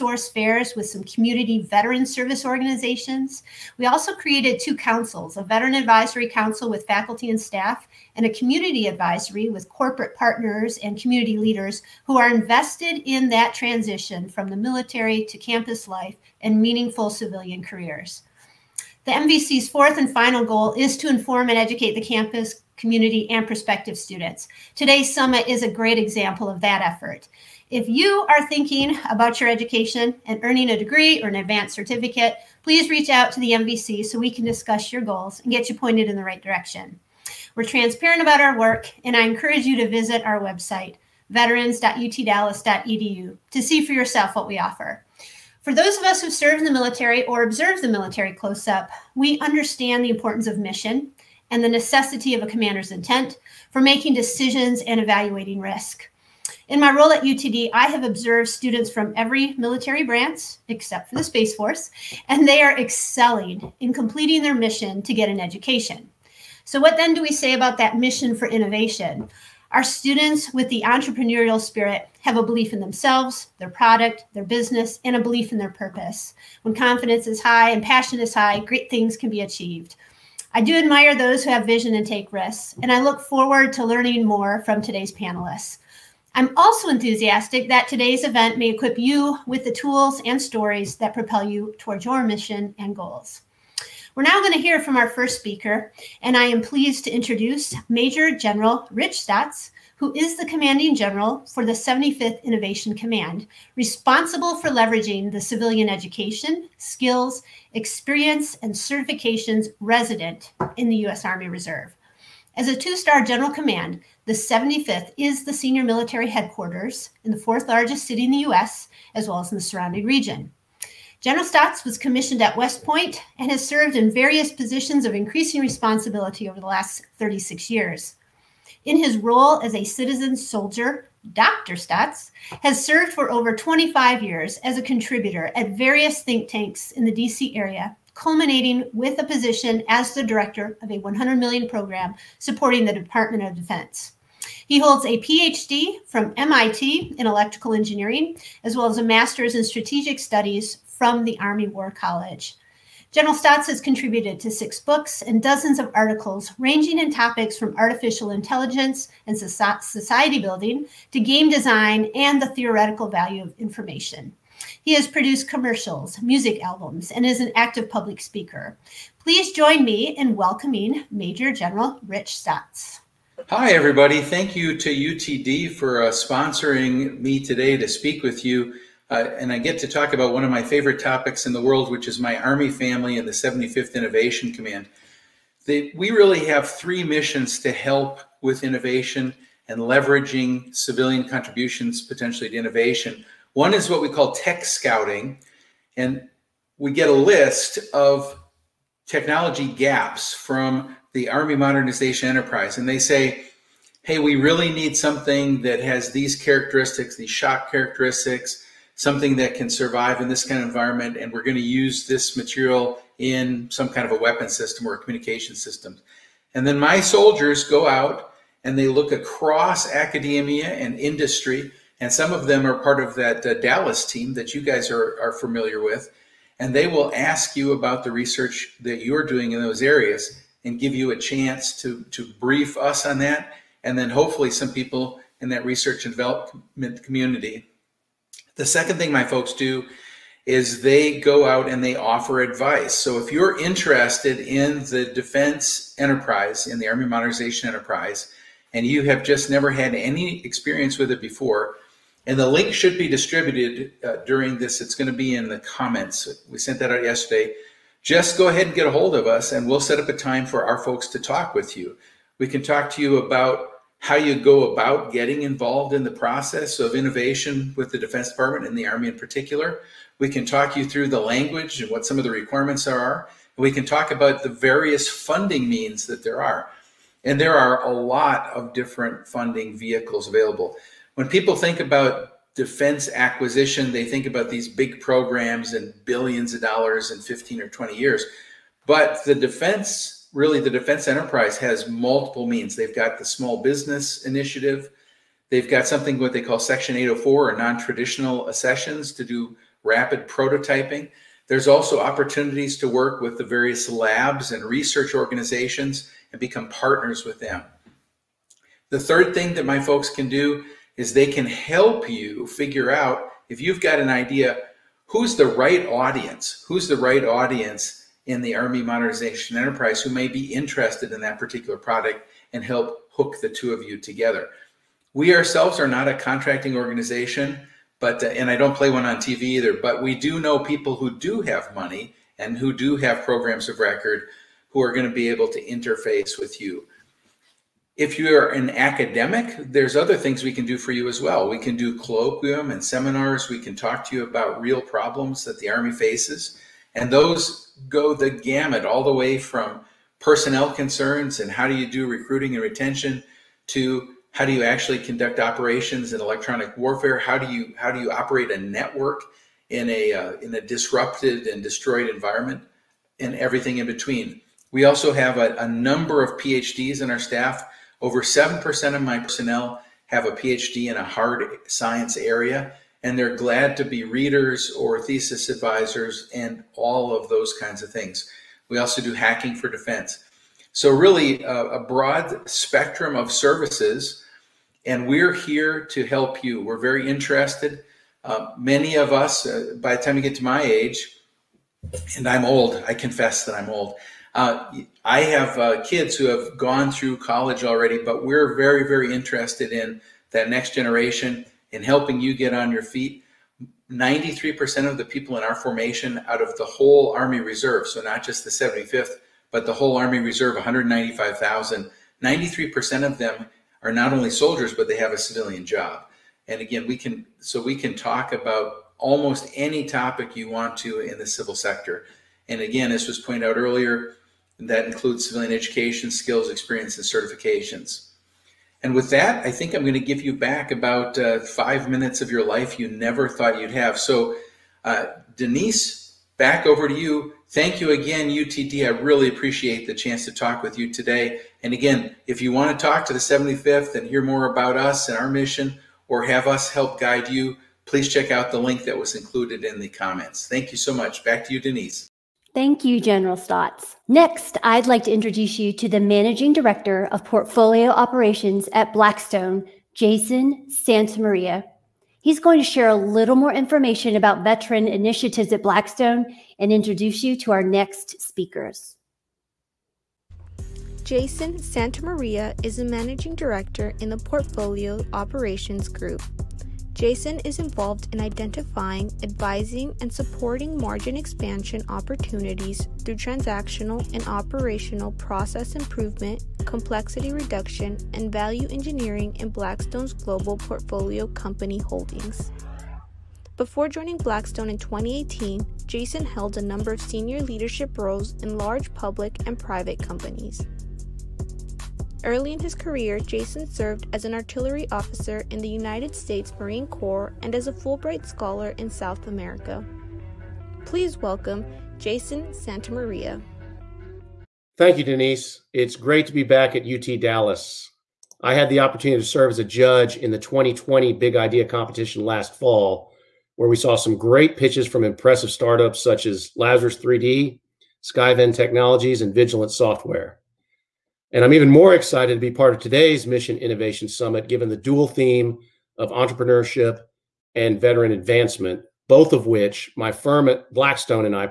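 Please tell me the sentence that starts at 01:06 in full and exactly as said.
So, what then do we say about that mission for innovation?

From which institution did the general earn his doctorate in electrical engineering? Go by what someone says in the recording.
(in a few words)
MIT.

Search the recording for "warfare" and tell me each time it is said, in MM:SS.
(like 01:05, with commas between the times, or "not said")
05:56.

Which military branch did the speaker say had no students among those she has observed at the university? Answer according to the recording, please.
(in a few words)
Space Force.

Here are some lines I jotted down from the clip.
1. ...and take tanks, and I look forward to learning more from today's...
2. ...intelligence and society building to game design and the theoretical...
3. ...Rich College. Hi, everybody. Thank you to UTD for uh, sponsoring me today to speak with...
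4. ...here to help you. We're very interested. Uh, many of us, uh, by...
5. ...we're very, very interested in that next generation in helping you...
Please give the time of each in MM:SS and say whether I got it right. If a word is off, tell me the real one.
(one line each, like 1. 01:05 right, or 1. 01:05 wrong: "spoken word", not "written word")
1. 01:21 wrong: "risks", not "tanks"
2. 02:38 right
3. 02:52 wrong: "Staats", not "College"
4. 06:25 right
5. 06:38 right.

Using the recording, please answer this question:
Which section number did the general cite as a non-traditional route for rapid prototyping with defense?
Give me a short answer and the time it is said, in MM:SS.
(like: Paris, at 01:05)
804, at 04:56.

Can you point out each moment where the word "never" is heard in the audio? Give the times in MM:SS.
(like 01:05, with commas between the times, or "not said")
04:09, 07:12.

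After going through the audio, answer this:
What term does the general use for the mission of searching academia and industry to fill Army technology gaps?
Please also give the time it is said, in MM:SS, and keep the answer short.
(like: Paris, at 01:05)
tech scouting, at 03:14.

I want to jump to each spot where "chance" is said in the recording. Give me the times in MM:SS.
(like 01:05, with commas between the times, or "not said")
03:51, 07:19.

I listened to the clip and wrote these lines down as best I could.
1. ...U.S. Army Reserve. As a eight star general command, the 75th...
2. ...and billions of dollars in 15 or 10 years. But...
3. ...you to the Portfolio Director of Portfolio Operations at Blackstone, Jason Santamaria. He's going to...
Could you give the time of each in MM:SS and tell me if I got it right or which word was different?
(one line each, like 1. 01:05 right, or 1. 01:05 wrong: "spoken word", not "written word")
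1. 01:51 wrong: "two", not "eight"
2. 04:45 wrong: "20", not "10"
3. 07:35 wrong: "Managing", not "Portfolio".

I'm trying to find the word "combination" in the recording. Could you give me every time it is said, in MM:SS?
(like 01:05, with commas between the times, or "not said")
not said.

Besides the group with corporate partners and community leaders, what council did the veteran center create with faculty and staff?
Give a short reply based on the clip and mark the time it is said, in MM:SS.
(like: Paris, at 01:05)
veteran advisory council, at 00:05.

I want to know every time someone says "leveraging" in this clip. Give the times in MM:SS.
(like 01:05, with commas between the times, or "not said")
01:44, 03:09.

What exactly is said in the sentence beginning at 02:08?
In his role as a citizen soldier, Dr.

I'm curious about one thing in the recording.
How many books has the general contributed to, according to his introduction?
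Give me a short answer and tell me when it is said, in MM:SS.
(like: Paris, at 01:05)
6, at 02:34.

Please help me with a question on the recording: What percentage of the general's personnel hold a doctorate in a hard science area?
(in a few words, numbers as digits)
over 7%.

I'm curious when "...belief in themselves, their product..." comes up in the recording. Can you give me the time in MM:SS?
01:12.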